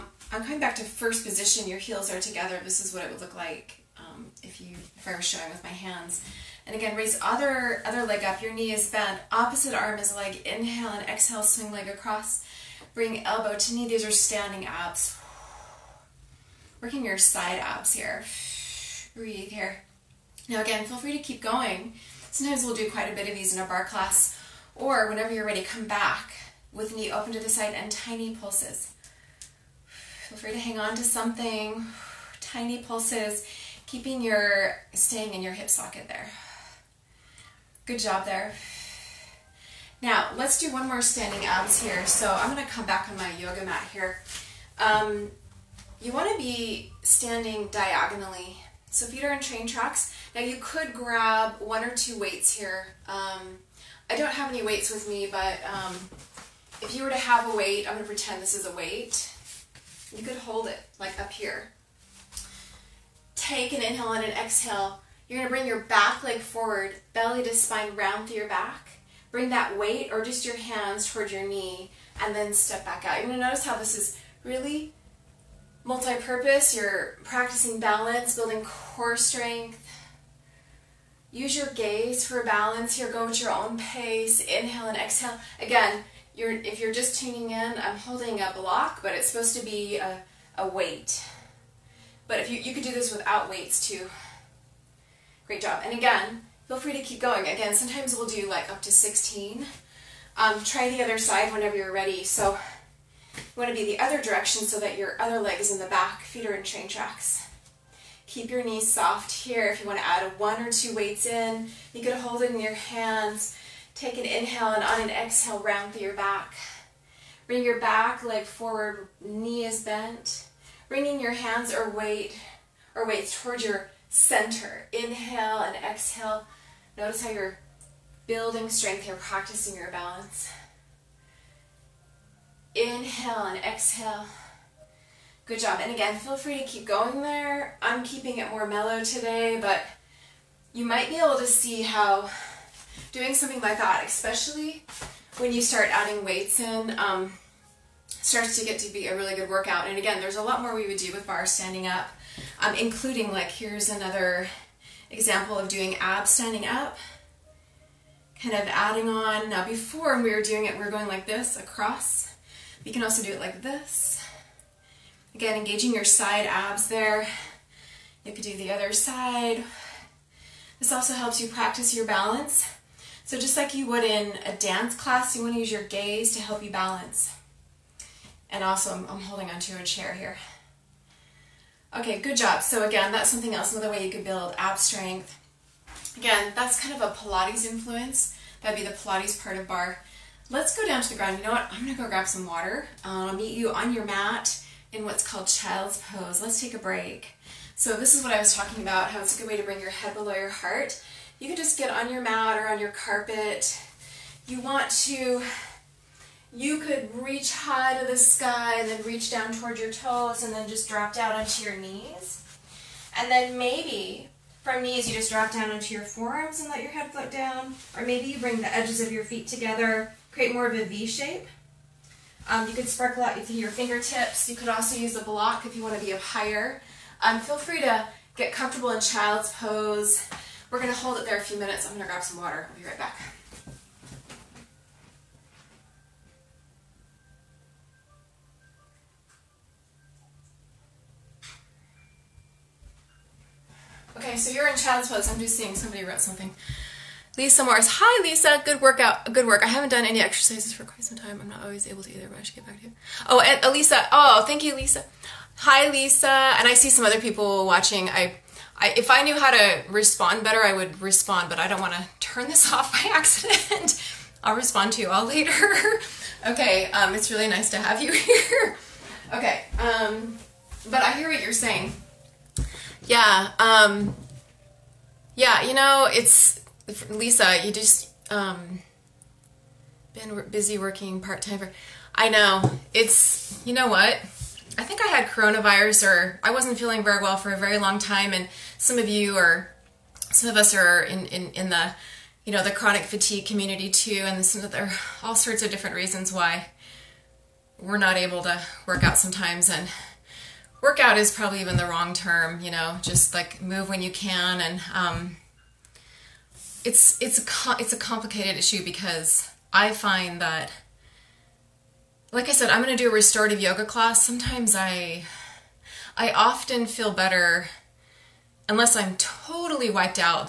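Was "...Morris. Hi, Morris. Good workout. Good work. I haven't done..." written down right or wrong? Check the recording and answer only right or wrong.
wrong.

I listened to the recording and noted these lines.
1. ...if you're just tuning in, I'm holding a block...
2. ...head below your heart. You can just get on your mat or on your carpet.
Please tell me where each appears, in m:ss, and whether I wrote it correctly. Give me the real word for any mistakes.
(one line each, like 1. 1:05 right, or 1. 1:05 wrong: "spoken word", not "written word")
1. 1:26 right
2. 3:19 right.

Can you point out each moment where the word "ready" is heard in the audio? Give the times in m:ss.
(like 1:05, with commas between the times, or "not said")
0:25, 1:41.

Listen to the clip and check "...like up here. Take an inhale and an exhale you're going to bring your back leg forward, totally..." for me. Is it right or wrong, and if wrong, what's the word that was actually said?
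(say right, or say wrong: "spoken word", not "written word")
wrong: "belly", not "totally".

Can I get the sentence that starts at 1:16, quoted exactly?
You're practicing balance, building core strength.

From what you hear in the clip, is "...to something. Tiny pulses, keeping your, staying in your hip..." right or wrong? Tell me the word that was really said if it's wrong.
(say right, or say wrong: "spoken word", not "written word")
right.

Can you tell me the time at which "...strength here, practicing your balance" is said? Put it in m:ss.
2:08.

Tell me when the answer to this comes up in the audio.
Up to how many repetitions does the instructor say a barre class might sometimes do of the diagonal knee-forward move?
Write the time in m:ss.
1:38.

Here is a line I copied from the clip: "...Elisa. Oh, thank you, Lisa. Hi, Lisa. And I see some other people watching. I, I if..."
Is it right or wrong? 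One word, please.
right.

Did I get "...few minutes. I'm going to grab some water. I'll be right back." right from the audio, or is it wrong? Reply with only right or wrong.
right.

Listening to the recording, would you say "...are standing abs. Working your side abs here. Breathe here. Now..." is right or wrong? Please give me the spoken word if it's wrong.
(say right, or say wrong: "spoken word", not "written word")
right.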